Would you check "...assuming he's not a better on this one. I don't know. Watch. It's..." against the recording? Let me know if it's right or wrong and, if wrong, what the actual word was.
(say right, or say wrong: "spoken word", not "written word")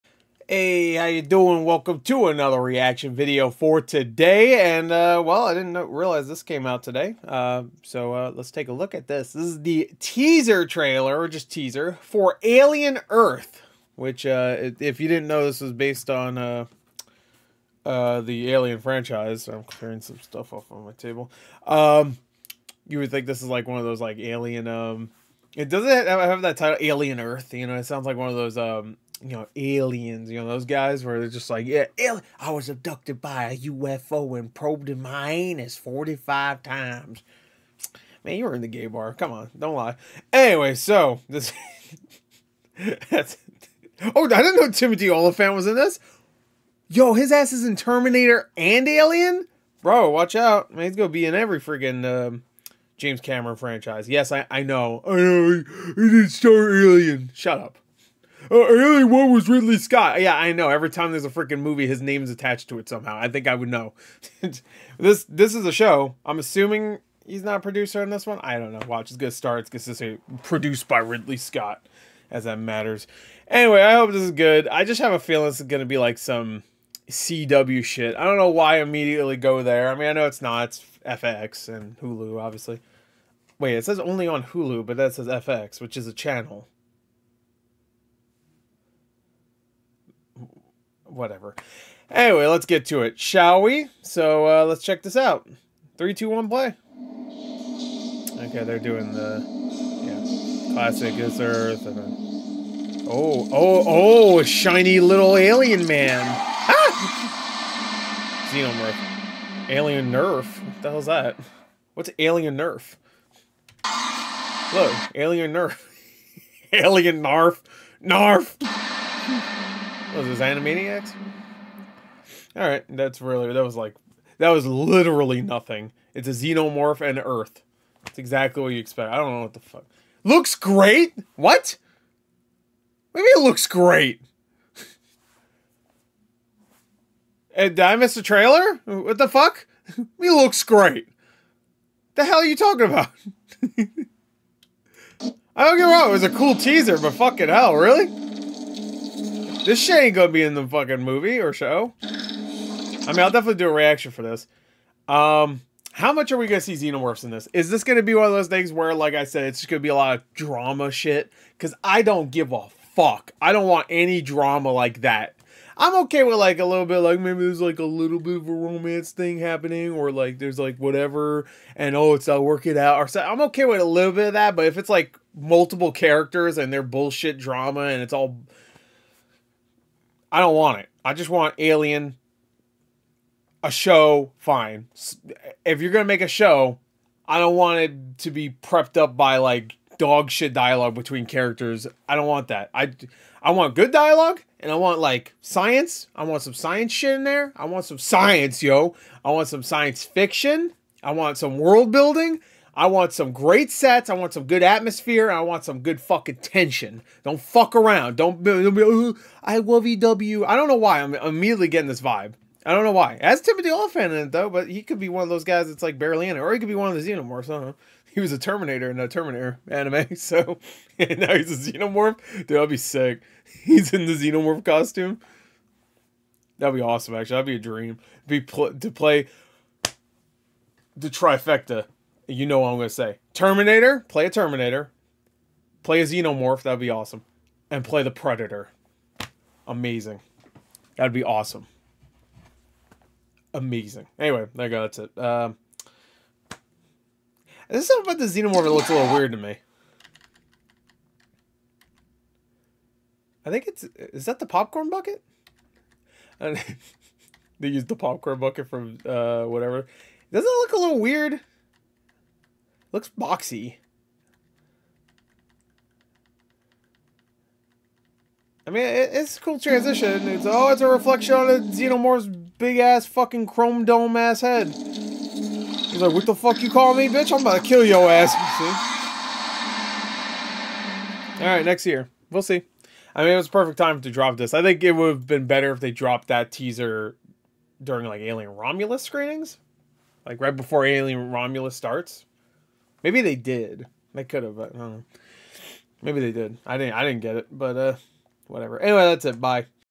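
wrong: "producer", not "better".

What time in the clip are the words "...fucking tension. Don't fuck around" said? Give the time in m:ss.
3:26.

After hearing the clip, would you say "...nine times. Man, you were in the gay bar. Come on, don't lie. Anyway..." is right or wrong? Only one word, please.
wrong.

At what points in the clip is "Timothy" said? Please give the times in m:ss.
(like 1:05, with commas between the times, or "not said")
0:44, 3:33.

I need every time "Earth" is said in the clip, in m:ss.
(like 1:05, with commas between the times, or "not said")
0:13, 0:27, 1:41, 2:07.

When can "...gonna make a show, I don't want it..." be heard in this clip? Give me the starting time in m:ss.
3:05.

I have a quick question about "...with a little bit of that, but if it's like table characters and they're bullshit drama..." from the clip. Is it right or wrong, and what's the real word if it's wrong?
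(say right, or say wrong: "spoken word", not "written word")
wrong: "multiple", not "table".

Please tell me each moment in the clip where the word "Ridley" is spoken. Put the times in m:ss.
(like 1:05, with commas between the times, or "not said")
0:59, 1:10.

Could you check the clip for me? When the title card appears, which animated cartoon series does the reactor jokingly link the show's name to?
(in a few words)
Animaniacs.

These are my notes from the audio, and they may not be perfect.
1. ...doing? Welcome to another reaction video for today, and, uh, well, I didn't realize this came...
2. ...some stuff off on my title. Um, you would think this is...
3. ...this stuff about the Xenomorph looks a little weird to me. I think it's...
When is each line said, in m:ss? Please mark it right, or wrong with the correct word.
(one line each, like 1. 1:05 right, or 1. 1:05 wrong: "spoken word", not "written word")
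1. 0:01 right
2. 0:20 wrong: "table", not "title"
3. 4:07 right.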